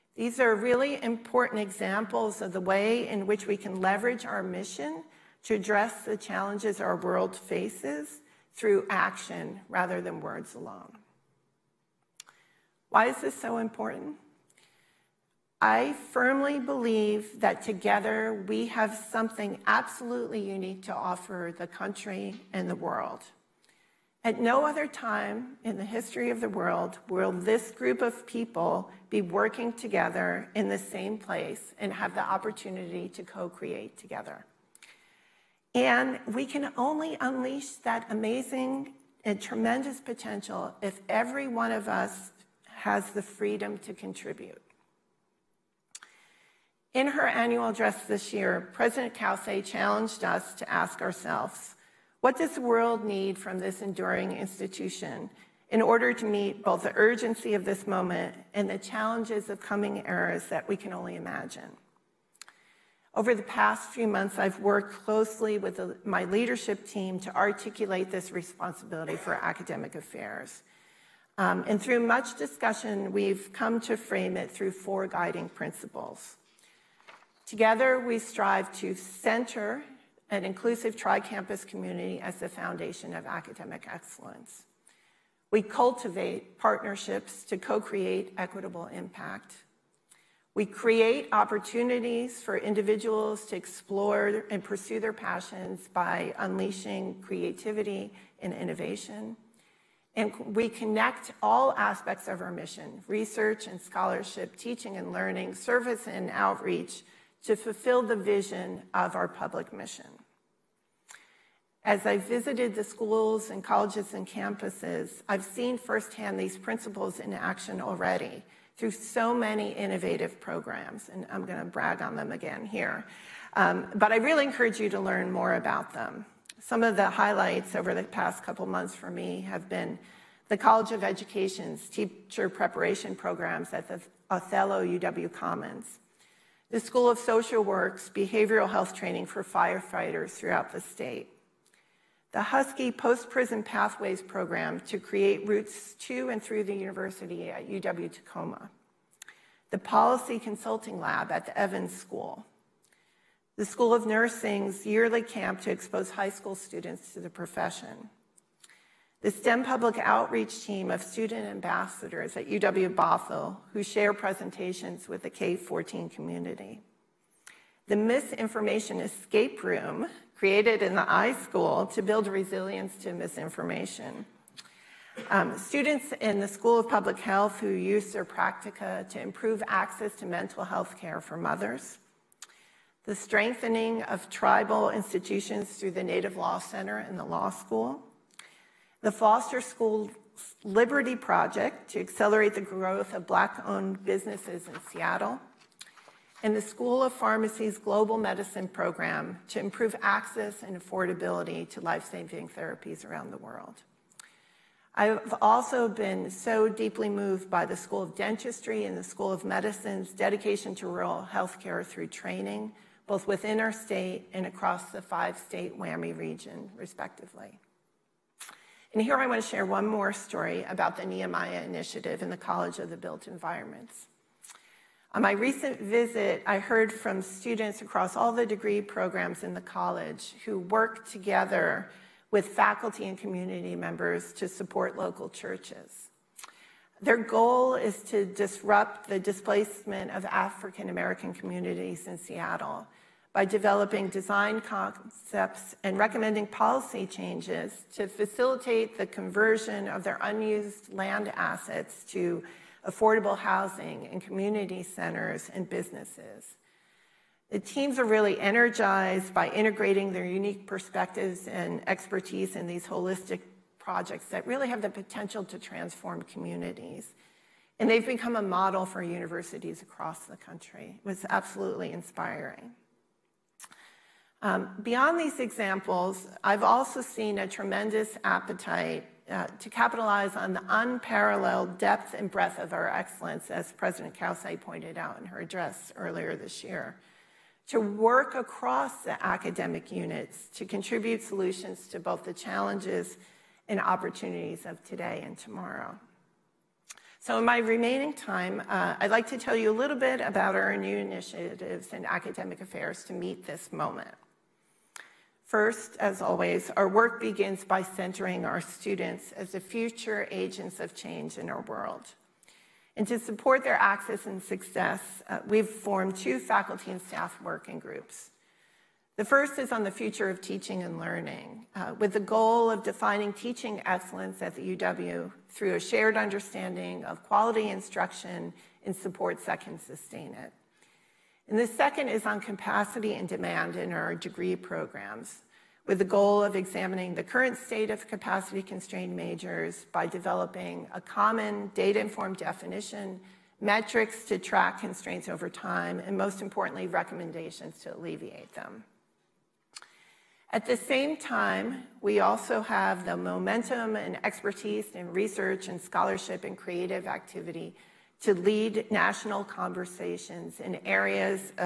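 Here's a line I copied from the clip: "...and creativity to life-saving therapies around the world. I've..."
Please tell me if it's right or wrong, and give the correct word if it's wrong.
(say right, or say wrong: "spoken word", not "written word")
wrong: "affordability", not "creativity".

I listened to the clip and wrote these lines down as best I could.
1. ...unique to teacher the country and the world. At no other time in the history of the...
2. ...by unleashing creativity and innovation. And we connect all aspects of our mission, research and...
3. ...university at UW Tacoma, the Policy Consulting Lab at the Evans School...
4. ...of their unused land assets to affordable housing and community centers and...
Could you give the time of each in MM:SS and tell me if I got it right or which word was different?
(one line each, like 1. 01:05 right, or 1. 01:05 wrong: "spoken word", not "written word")
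1. 00:20 wrong: "offer", not "teacher"
2. 01:35 right
3. 02:26 right
4. 04:09 right.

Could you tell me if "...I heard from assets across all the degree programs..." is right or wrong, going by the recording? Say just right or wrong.
wrong.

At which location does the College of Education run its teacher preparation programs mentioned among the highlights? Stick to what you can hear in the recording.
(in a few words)
Othello UW Commons.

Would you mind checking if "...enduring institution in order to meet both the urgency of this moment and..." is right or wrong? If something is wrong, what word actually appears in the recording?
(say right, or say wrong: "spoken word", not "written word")
right.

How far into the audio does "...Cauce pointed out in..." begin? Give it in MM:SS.
04:44.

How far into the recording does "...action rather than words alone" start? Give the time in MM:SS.
00:08.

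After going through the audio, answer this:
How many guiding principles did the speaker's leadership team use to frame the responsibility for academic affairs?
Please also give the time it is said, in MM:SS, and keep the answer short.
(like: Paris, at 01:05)
4, at 01:14.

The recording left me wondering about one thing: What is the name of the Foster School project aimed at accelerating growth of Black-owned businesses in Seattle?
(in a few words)
Liberty Project.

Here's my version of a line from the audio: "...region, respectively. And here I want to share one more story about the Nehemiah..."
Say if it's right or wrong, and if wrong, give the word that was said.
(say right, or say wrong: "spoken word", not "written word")
right.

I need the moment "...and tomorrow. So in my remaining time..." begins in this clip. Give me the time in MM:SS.
04:55.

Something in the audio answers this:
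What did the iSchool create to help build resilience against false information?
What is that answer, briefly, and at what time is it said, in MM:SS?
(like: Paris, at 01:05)
Misinformation Escape Room, at 02:47.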